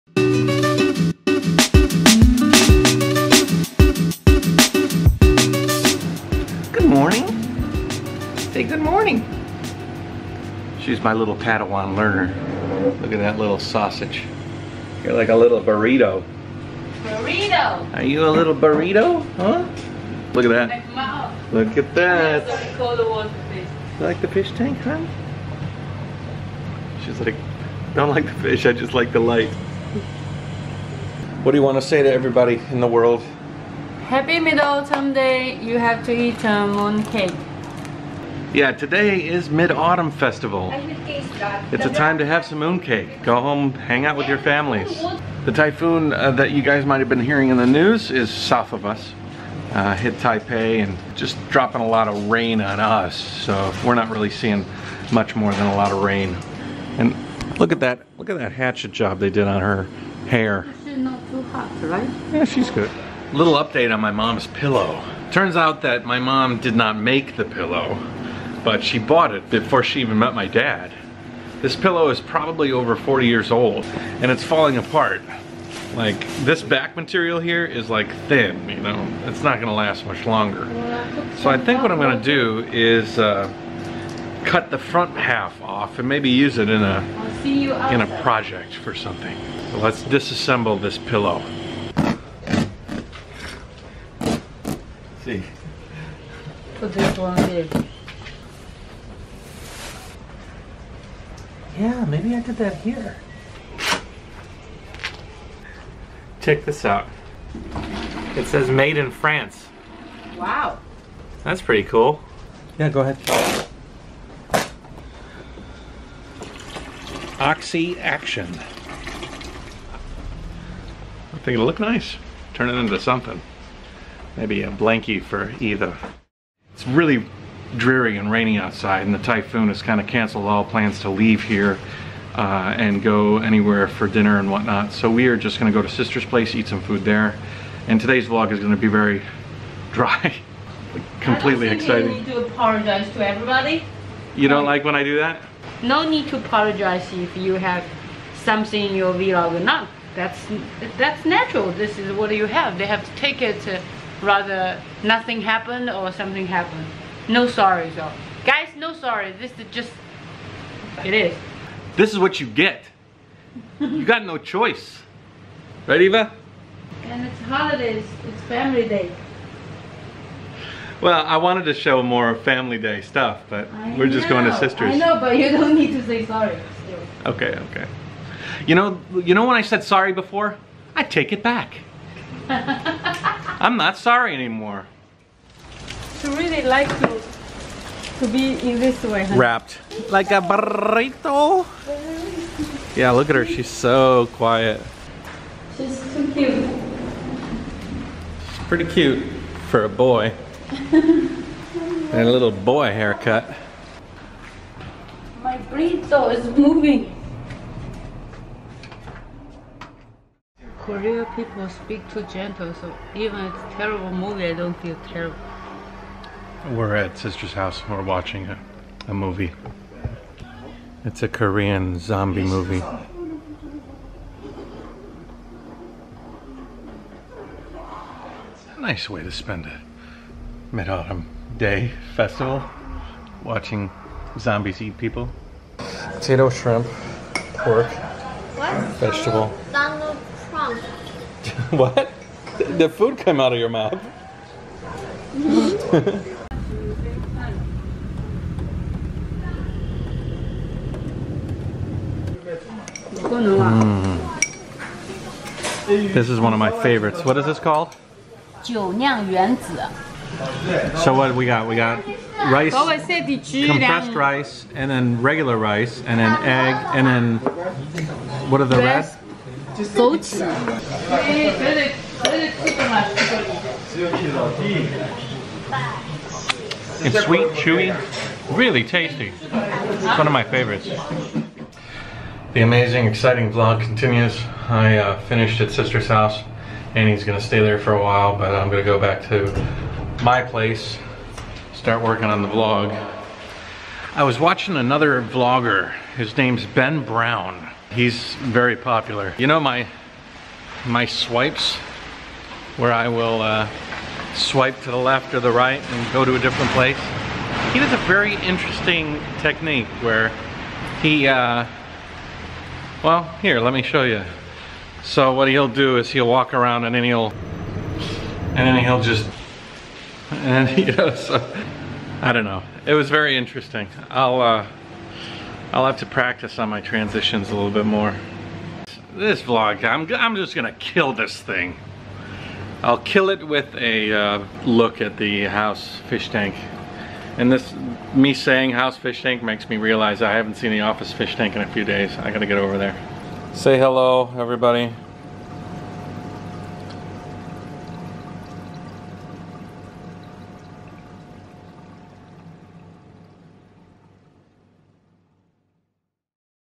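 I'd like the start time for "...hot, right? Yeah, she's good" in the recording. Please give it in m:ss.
1:01.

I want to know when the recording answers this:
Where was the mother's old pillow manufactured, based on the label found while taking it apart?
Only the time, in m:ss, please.
1:49.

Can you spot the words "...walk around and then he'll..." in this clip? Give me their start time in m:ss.
5:16.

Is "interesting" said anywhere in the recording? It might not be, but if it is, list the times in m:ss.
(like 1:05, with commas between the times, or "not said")
5:08, 5:23.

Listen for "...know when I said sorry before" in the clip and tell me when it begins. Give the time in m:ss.
2:59.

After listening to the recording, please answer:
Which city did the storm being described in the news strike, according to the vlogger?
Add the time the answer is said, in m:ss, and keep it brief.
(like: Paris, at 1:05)
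Taipei, at 0:50.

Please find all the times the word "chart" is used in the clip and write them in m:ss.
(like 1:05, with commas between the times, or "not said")
not said.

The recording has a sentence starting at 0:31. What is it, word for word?
What do you want to say to everybody in the world?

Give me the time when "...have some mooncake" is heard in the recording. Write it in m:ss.
0:42.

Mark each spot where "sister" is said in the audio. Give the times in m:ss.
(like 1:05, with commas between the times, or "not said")
2:15, 2:54, 3:37, 4:45.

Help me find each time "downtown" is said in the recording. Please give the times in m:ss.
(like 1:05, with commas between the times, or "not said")
not said.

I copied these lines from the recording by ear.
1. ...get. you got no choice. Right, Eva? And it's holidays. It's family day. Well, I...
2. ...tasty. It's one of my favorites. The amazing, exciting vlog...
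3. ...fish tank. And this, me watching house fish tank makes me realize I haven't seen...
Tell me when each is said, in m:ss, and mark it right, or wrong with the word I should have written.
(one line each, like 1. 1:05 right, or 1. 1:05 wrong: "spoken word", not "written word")
1. 2:42 right
2. 4:38 right
3. 5:36 wrong: "saying", not "watching".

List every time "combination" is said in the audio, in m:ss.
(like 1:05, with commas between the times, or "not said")
not said.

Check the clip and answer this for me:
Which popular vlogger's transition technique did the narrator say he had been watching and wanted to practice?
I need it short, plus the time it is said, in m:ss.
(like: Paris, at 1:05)
Ben Brown, at 4:56.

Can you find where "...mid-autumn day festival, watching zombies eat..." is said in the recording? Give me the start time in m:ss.
3:50.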